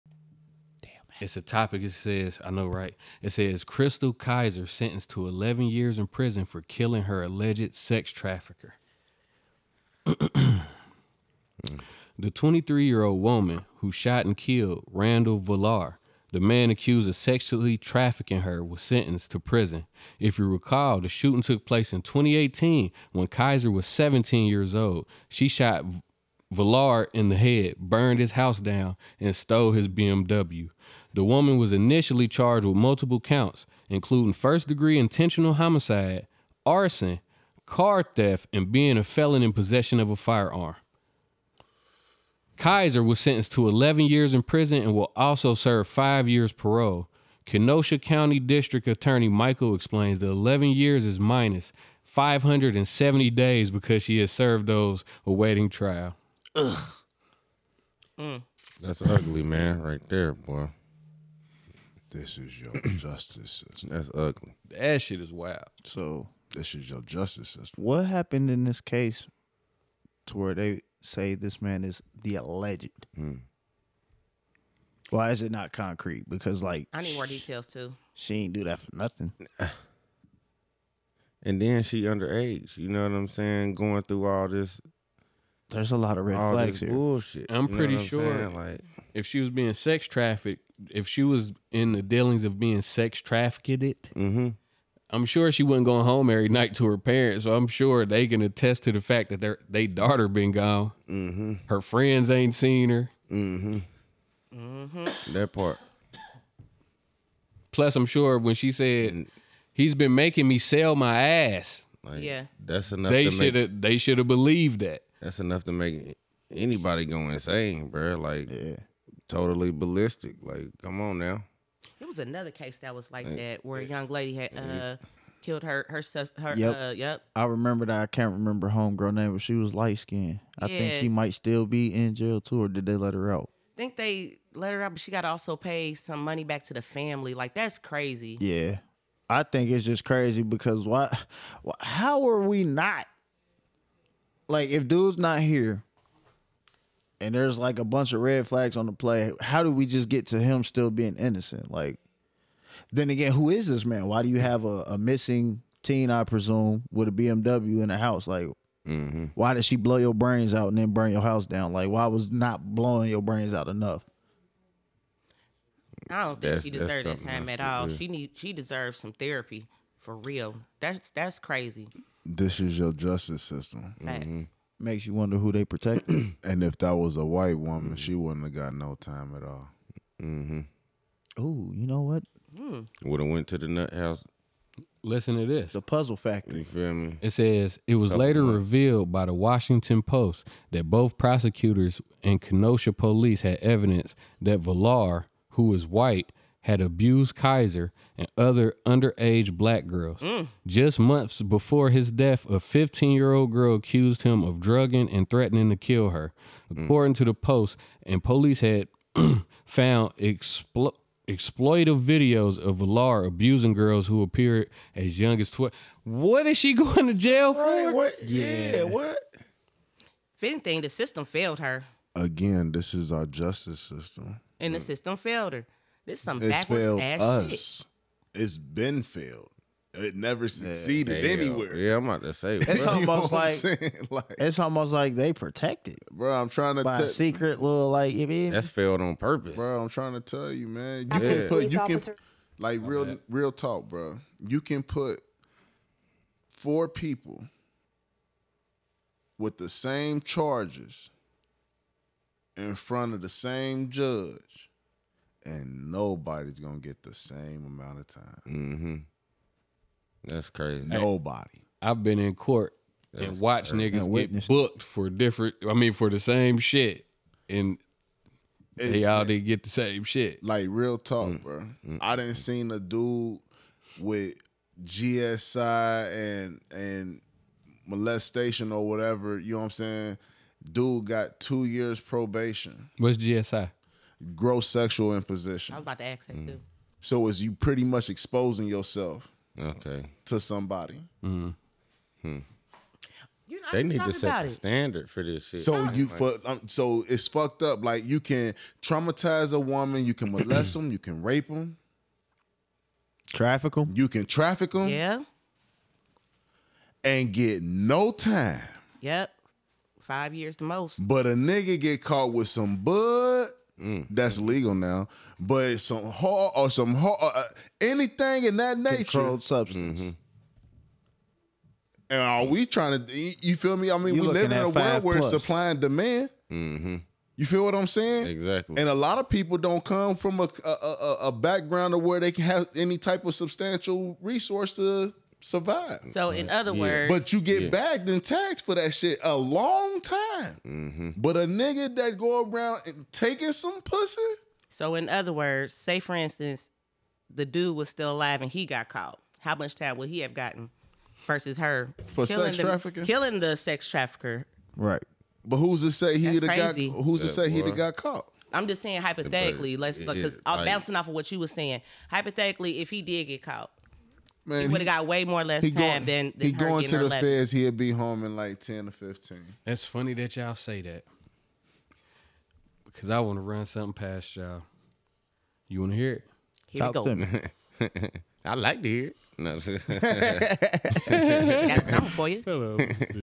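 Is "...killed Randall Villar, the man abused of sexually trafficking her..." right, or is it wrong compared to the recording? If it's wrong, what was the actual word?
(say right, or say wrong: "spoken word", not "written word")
wrong: "accused", not "abused".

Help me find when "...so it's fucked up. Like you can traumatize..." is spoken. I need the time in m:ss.
4:56.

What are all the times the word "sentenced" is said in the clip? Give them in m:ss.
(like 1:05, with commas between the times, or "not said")
0:04, 0:18, 0:43.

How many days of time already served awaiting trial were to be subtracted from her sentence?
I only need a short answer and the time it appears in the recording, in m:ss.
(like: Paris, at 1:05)
570, at 0:52.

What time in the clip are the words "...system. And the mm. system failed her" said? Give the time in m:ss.
3:43.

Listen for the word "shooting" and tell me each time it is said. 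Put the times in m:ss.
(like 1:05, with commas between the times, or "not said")
0:21.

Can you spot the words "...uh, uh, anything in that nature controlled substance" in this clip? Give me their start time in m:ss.
5:17.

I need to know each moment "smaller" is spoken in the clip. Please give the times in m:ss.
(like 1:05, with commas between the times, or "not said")
not said.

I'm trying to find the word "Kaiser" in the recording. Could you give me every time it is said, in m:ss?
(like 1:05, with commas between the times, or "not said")
0:04, 0:23, 3:17.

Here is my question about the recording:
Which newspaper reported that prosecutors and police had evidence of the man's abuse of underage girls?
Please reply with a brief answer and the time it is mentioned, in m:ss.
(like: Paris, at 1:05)
Washington Post, at 3:09.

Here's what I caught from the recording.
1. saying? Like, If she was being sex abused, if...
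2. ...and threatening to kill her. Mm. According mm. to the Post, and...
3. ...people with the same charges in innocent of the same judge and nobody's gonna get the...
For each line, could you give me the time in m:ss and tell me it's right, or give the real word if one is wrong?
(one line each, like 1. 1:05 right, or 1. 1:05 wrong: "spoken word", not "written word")
1. 1:28 wrong: "trafficked", not "abused"
2. 3:25 right
3. 4:06 wrong: "front", not "innocent".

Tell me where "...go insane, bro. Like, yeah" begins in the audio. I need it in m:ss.
1:57.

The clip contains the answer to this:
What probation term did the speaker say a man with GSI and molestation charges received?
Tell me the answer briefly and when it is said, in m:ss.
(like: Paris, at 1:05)
2 years probation, at 4:41.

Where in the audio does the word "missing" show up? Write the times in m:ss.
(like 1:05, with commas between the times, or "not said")
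2:34.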